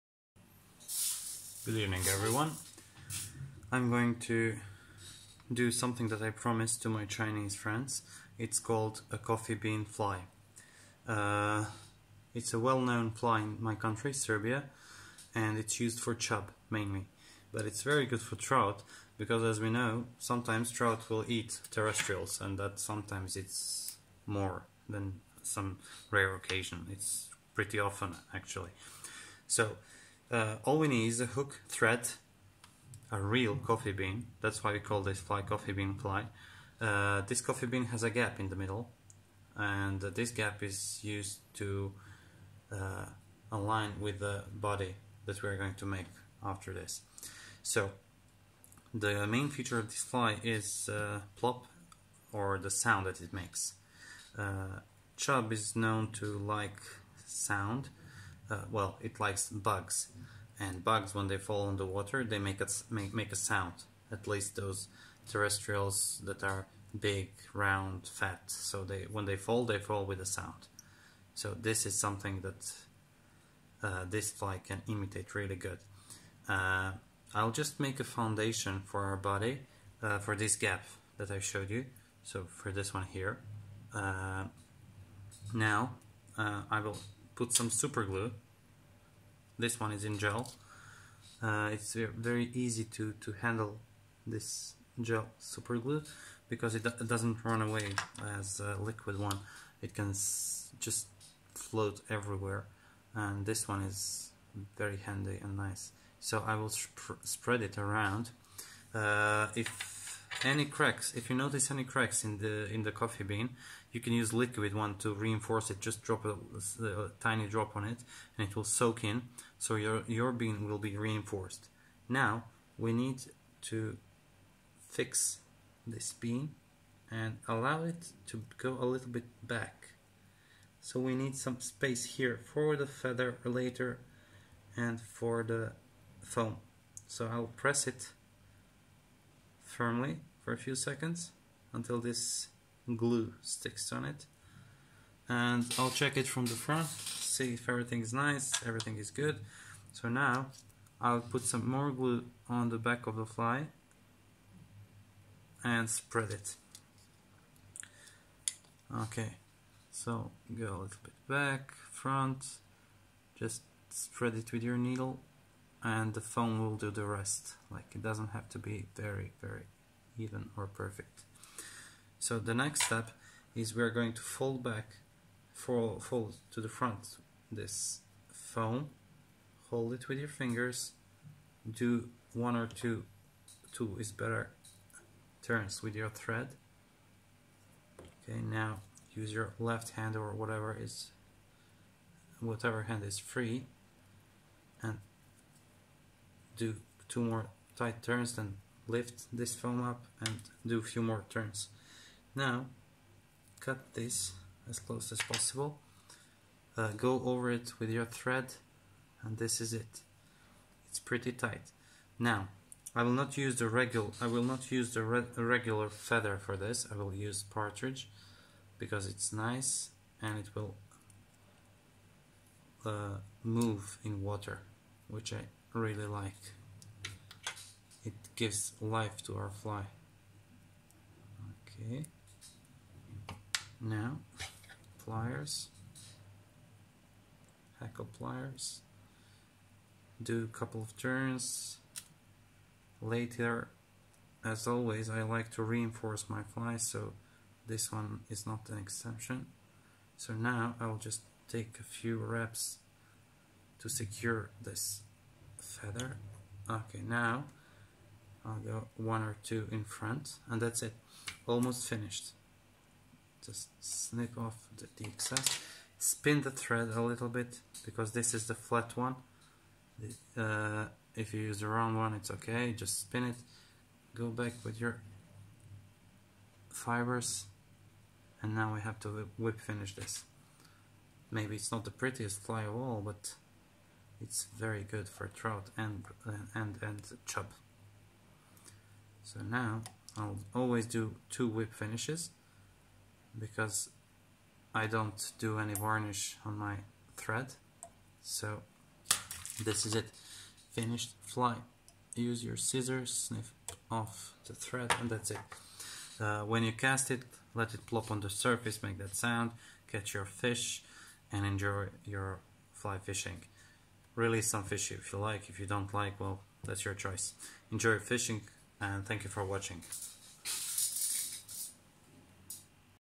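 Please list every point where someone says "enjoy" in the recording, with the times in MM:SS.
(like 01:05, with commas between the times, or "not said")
05:11, 05:17.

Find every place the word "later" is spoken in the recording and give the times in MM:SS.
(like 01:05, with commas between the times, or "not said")
02:13, 04:03.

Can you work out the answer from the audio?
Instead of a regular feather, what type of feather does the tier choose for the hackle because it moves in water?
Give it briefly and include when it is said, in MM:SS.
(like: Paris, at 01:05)
Partridge, at 03:37.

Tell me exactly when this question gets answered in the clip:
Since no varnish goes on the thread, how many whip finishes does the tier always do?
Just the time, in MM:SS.
04:51.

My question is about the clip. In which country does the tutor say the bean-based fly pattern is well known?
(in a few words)
Serbia.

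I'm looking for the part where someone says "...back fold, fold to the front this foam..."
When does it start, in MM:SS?
02:54.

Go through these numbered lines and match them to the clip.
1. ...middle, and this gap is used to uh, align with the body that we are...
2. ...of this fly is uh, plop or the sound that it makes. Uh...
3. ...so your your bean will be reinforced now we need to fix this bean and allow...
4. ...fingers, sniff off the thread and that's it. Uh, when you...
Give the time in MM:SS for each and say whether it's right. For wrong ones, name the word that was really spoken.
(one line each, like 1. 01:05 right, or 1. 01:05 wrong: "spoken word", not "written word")
1. 00:38 right
2. 00:49 right
3. 01:59 right
4. 05:02 wrong: "scissors", not "fingers".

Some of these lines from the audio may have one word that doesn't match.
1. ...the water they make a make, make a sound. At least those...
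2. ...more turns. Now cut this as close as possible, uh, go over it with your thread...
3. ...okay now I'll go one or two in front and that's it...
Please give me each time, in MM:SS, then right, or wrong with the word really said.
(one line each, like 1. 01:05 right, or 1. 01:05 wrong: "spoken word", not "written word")
1. 01:01 right
2. 03:21 right
3. 04:16 right.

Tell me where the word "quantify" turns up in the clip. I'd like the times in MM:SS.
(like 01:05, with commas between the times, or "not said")
not said.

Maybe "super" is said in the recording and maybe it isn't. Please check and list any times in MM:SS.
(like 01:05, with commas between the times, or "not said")
01:27, 01:35.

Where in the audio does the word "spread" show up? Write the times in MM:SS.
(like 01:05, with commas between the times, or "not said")
01:47, 02:35, 02:43.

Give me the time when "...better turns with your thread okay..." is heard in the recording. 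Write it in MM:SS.
03:04.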